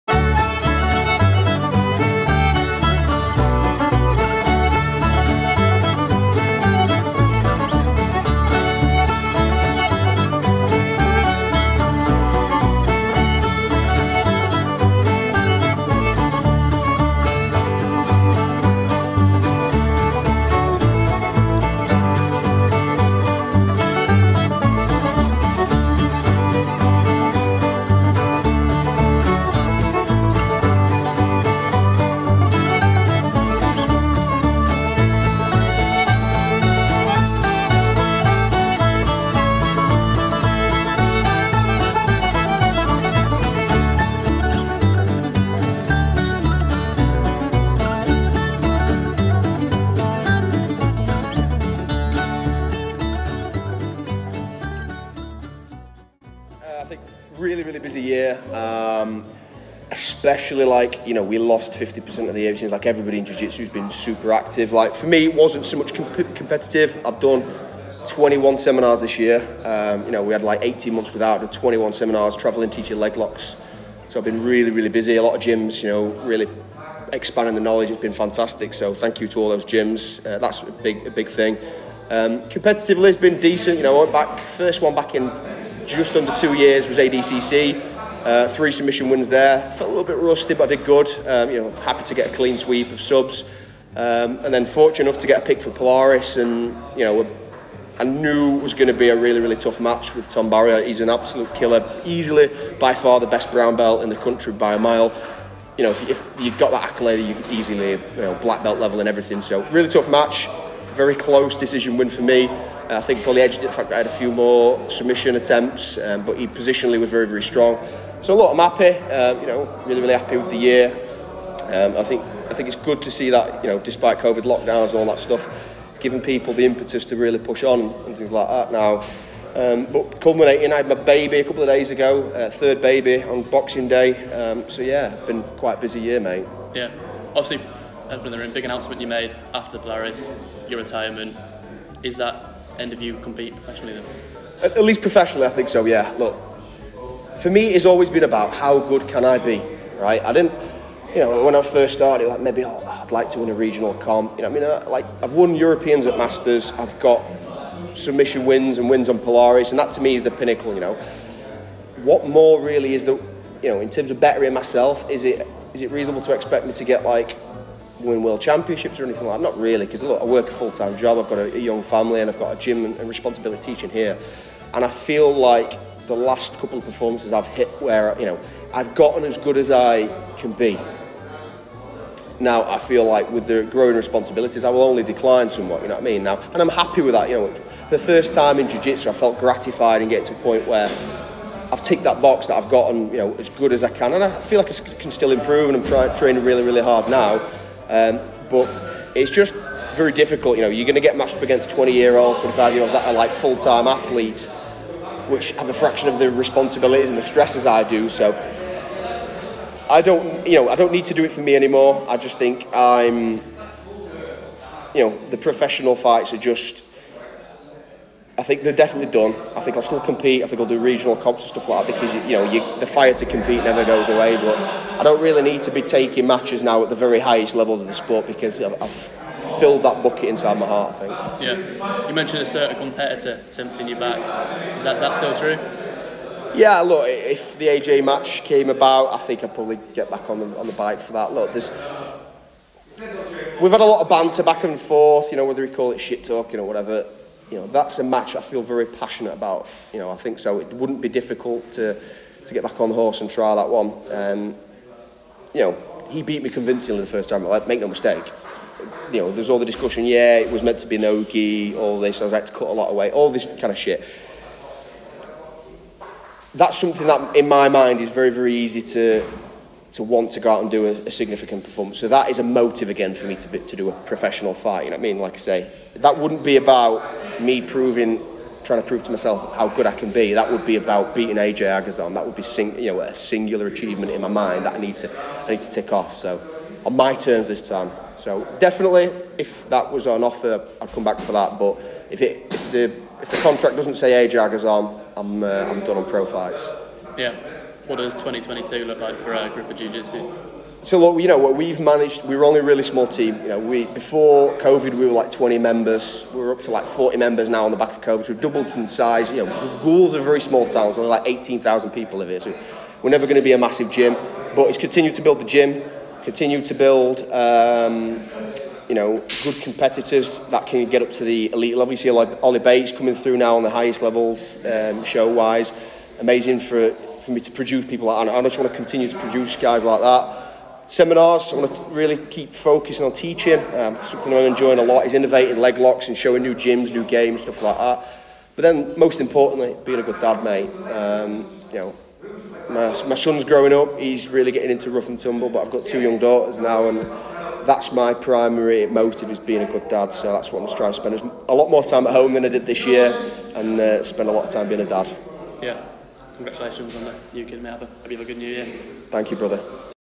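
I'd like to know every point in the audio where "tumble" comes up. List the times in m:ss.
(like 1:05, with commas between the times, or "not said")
5:45.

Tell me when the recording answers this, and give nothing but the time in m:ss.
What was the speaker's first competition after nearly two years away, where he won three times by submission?
1:26.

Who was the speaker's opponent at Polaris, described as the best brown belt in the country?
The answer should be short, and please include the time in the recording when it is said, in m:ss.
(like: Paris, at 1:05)
Tom Barrier, at 1:40.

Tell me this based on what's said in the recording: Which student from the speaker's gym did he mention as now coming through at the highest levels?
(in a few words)
Ollie Bates.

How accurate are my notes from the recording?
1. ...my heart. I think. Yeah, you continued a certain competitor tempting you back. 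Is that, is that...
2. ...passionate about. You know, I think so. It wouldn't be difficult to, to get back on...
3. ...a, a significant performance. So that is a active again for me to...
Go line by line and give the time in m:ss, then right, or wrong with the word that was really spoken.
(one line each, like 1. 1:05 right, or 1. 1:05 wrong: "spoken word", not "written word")
1. 3:50 wrong: "mentioned", not "continued"
2. 4:08 right
3. 4:30 wrong: "motive", not "active".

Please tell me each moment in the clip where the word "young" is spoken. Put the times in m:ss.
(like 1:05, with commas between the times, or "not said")
2:51, 5:46.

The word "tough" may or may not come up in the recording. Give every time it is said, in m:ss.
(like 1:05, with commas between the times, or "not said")
1:39, 1:49.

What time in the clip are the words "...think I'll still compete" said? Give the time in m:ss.
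3:39.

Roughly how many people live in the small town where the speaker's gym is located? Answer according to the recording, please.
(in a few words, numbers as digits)
18,000.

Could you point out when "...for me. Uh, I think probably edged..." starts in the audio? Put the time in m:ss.
1:52.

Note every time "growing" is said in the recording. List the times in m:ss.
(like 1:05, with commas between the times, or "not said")
3:03, 5:43.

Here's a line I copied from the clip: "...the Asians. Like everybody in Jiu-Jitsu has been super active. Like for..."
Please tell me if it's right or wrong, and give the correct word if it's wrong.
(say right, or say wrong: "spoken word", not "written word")
right.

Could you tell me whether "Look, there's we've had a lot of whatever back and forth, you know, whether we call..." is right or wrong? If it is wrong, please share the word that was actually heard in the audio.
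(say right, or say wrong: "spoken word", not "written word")
wrong: "banter", not "whatever".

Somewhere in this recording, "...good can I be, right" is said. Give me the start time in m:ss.
2:28.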